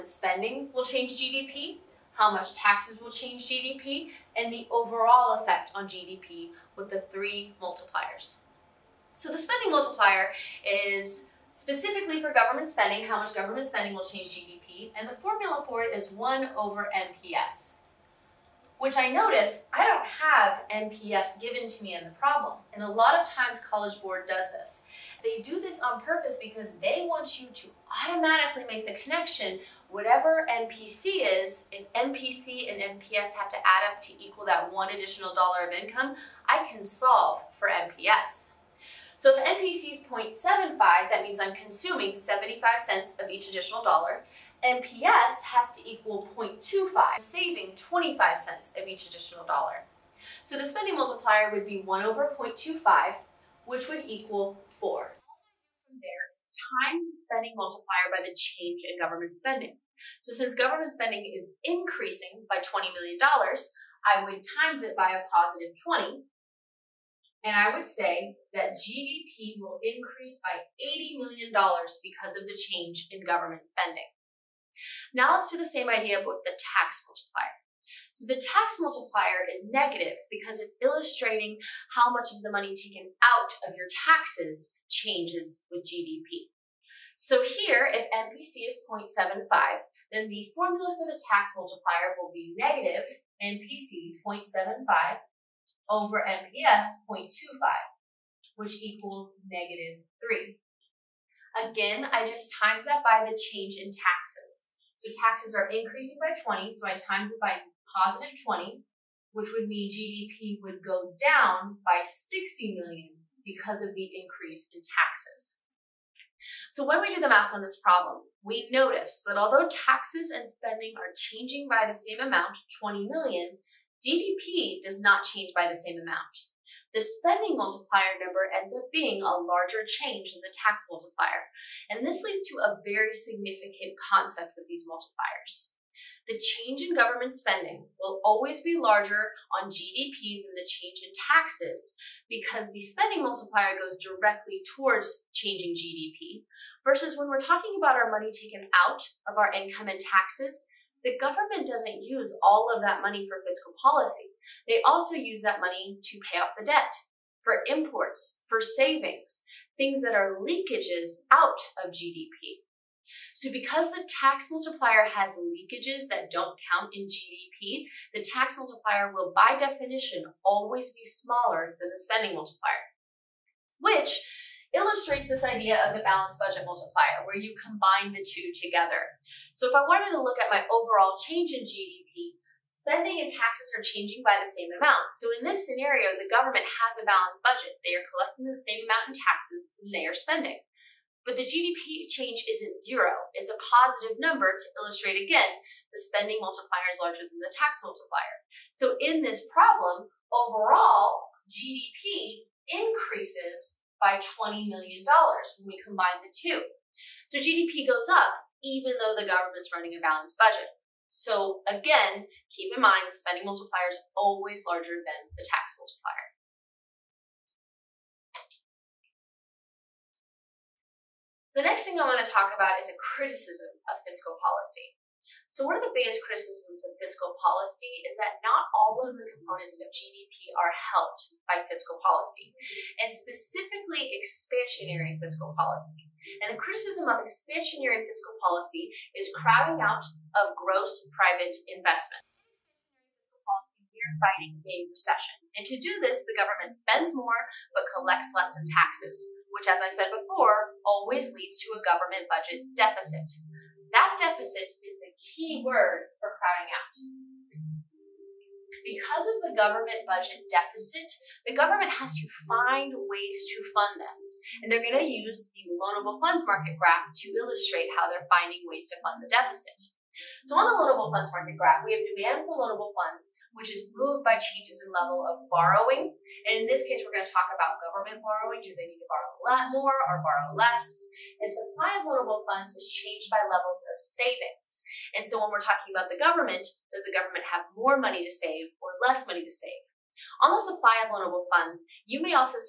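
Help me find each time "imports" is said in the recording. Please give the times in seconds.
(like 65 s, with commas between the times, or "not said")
157 s.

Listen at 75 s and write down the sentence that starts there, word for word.
Now let's do the same idea with the tax multiplier.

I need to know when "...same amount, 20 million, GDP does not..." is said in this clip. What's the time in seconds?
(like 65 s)
121 s.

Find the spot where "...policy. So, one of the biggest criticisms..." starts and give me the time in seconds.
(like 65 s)
224 s.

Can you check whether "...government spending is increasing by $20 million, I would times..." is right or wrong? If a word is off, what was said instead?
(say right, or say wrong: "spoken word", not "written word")
right.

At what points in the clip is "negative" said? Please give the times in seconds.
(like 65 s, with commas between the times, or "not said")
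79 s, 92 s, 99 s.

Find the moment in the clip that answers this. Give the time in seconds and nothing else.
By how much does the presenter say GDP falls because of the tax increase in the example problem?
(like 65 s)
112 s.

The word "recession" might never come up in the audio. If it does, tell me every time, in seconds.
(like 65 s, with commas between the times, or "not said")
244 s.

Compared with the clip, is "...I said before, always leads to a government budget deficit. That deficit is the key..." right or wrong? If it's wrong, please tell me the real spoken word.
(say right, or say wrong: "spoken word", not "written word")
right.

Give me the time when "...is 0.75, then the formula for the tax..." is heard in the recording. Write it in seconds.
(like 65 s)
88 s.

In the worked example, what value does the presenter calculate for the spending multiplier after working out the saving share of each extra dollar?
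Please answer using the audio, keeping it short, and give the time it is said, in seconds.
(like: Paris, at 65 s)
4, at 54 s.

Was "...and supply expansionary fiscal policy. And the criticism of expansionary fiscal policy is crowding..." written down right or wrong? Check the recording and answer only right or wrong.
wrong.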